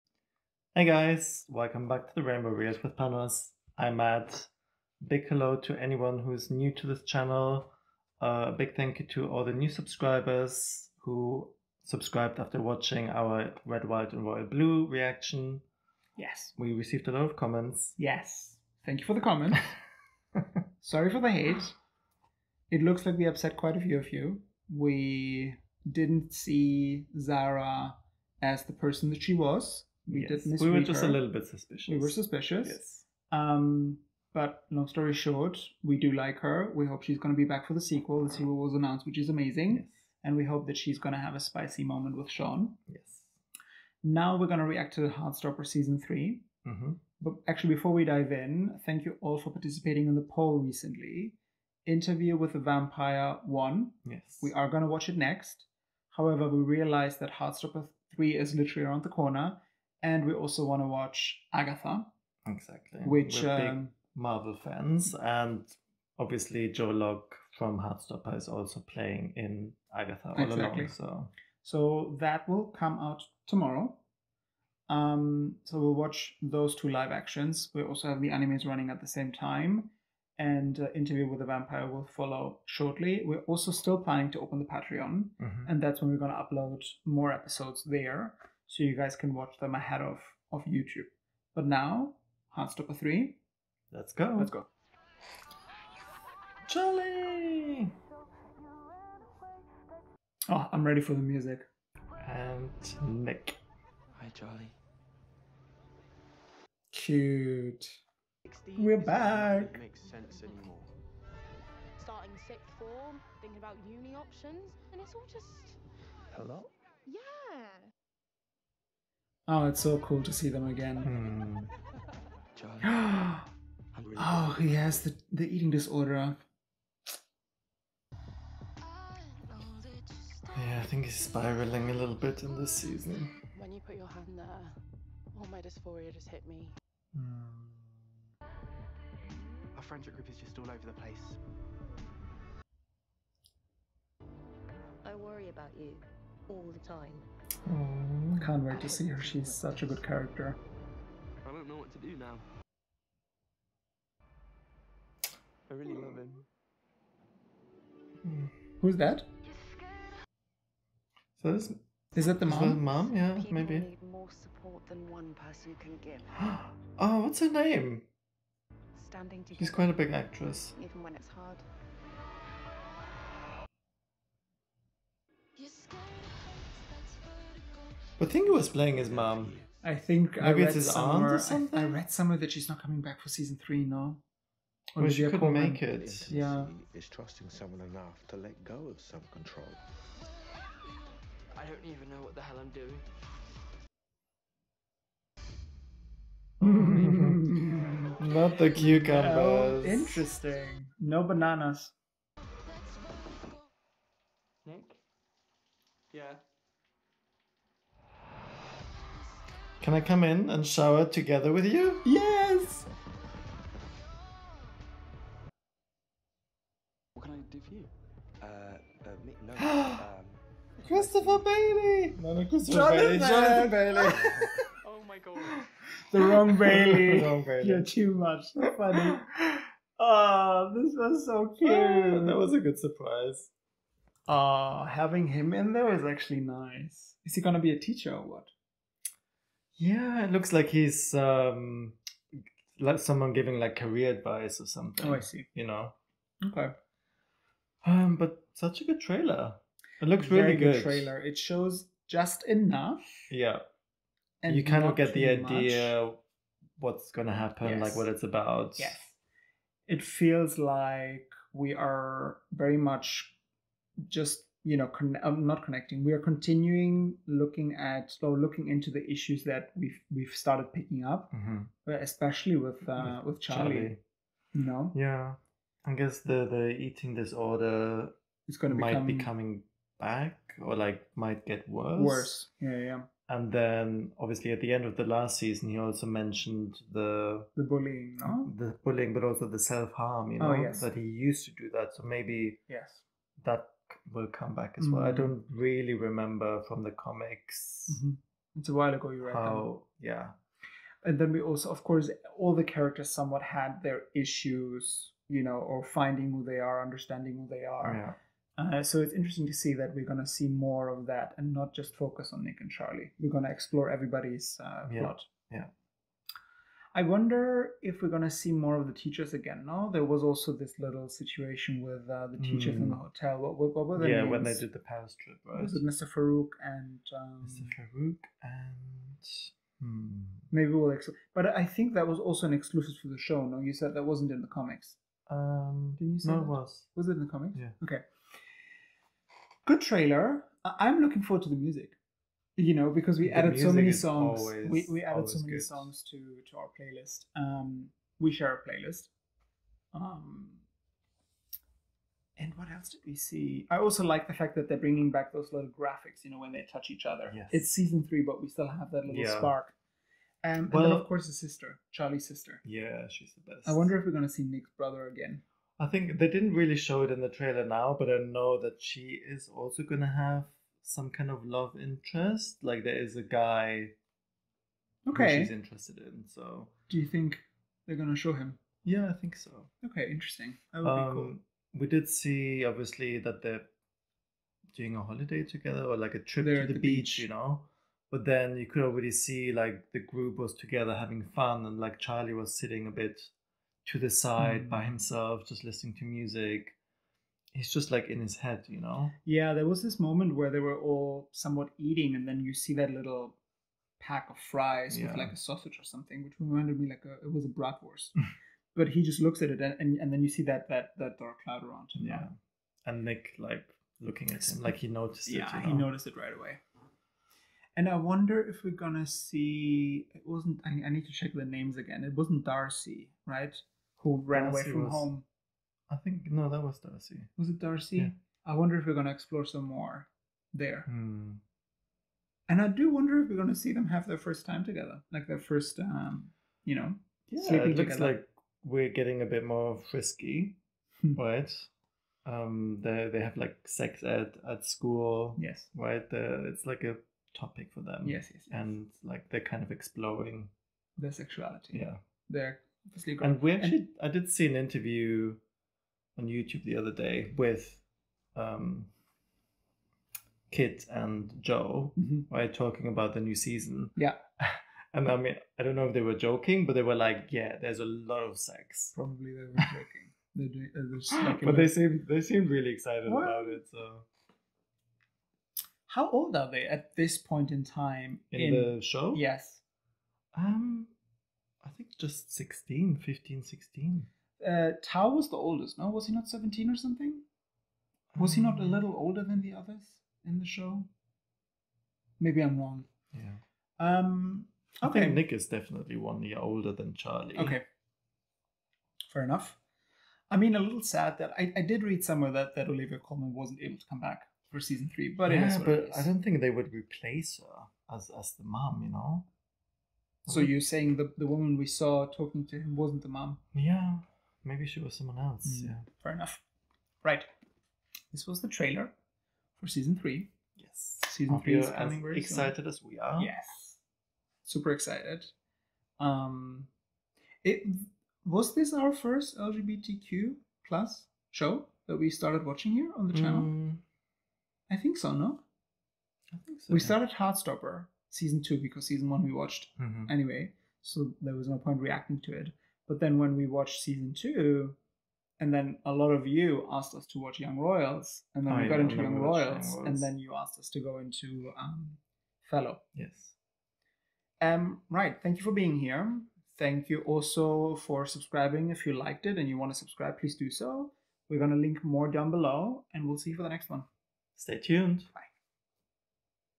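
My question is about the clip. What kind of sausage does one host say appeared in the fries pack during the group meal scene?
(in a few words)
bratwurst.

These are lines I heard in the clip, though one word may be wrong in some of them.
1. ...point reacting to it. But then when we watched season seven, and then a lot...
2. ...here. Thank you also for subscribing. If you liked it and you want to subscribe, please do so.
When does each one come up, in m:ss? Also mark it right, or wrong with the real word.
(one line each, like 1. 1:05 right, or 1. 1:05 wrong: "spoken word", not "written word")
1. 9:01 wrong: "two", not "seven"
2. 9:15 right.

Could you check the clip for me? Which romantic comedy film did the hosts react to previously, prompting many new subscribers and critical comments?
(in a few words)
Red, White, and Royal Blue.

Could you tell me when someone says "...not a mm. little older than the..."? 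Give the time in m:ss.
8:08.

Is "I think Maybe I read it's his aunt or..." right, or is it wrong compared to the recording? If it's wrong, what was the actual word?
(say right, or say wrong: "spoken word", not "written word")
right.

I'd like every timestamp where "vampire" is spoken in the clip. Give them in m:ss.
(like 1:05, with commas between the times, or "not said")
0:52, 1:21.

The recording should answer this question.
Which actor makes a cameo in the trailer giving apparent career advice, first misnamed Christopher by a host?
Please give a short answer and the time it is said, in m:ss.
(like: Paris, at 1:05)
Jonathan Bailey, at 3:42.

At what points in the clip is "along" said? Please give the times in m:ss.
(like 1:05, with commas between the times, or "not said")
1:10.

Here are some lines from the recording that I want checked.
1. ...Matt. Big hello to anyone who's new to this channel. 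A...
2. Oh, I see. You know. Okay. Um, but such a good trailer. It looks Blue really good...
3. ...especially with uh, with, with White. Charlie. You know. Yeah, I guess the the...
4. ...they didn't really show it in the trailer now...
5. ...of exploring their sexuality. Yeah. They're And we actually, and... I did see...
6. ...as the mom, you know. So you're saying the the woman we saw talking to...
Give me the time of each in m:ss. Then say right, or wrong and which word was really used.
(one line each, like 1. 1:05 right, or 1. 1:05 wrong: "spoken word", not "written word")
1. 0:03 right
2. 4:05 wrong: "Very", not "Blue"
3. 4:31 wrong: "Charlie", not "White"
4. 6:06 right
5. 7:29 right
6. 8:28 right.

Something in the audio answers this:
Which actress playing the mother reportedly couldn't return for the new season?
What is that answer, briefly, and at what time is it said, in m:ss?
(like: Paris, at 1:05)
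Olivia Colman, at 8:22.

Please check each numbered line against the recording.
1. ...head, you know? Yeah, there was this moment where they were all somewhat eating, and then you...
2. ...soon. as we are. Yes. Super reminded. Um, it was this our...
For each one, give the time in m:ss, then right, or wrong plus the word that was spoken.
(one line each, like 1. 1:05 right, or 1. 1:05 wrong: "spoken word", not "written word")
1. 6:38 right
2. 8:42 wrong: "excited", not "reminded".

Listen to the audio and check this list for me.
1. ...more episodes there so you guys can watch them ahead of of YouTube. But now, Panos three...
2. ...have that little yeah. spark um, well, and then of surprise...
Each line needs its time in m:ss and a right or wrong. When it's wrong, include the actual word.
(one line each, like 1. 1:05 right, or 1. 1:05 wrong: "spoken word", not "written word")
1. 1:27 wrong: "Heartstopper", not "Panos"
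2. 5:58 wrong: "course", not "surprise".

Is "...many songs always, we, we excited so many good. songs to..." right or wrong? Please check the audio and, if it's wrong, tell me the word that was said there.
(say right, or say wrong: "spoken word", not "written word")
wrong: "added", not "excited".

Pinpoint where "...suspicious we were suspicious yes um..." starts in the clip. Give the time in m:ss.
0:31.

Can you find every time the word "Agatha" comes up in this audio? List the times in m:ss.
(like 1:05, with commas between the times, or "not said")
1:01, 1:09.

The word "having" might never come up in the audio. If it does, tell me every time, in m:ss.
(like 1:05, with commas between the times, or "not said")
3:54, 6:30.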